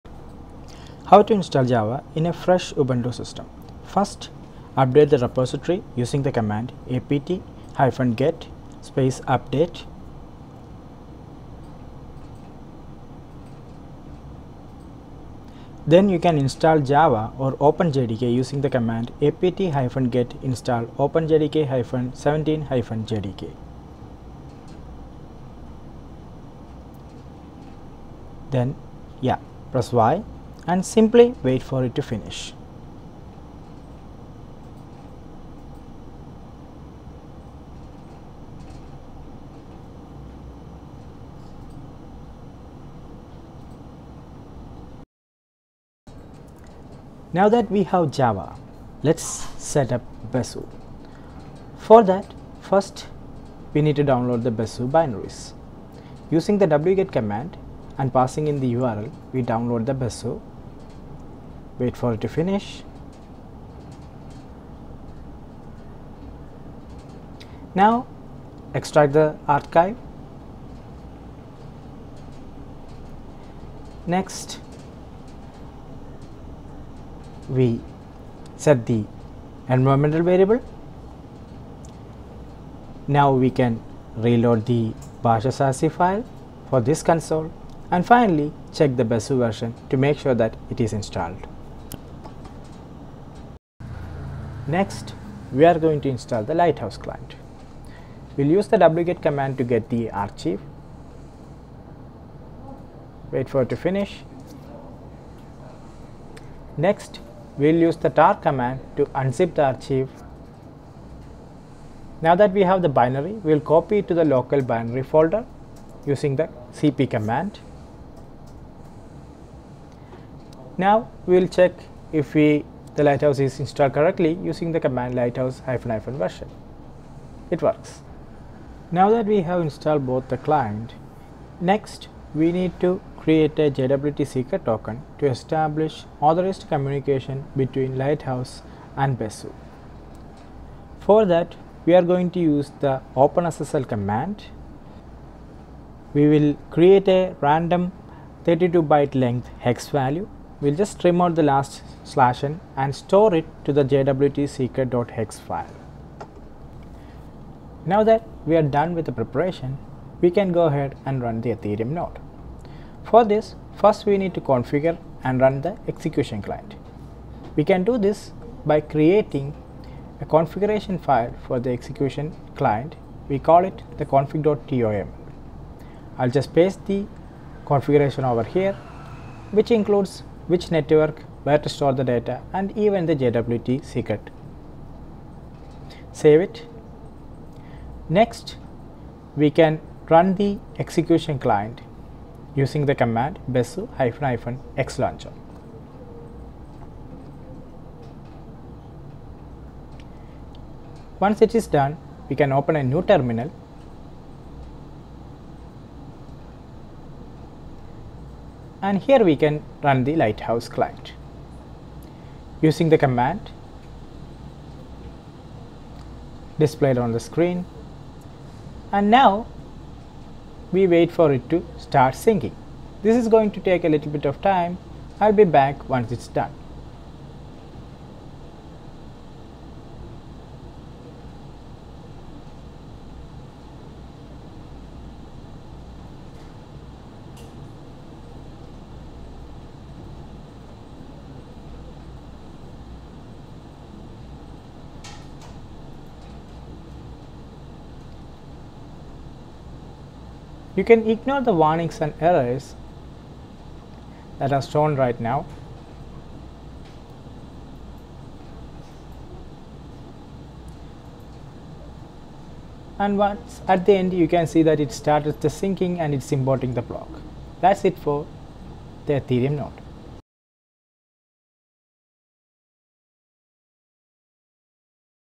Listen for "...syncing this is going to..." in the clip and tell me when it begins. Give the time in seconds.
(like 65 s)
222 s.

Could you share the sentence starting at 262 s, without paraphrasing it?
And once at the end you can see that it started the syncing and it's importing the block.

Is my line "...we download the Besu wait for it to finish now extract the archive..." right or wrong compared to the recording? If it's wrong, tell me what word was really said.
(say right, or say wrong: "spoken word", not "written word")
right.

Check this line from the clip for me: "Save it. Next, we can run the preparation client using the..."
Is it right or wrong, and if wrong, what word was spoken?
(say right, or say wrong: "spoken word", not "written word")
wrong: "execution", not "preparation".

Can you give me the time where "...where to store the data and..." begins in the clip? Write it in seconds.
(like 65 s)
181 s.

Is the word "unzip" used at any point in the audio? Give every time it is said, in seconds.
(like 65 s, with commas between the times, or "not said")
109 s.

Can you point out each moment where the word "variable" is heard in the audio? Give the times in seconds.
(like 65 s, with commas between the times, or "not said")
80 s.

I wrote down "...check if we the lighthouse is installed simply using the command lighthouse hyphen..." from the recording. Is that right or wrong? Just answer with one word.
wrong.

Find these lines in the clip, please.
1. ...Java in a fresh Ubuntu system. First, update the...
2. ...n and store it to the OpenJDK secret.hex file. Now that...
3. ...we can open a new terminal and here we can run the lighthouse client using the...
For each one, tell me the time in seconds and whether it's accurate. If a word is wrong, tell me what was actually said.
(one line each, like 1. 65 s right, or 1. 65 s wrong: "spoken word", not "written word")
1. 1 s right
2. 152 s wrong: "JWT", not "OpenJDK"
3. 202 s right.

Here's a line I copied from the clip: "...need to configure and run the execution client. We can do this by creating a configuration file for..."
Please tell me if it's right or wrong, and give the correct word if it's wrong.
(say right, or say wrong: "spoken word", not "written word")
right.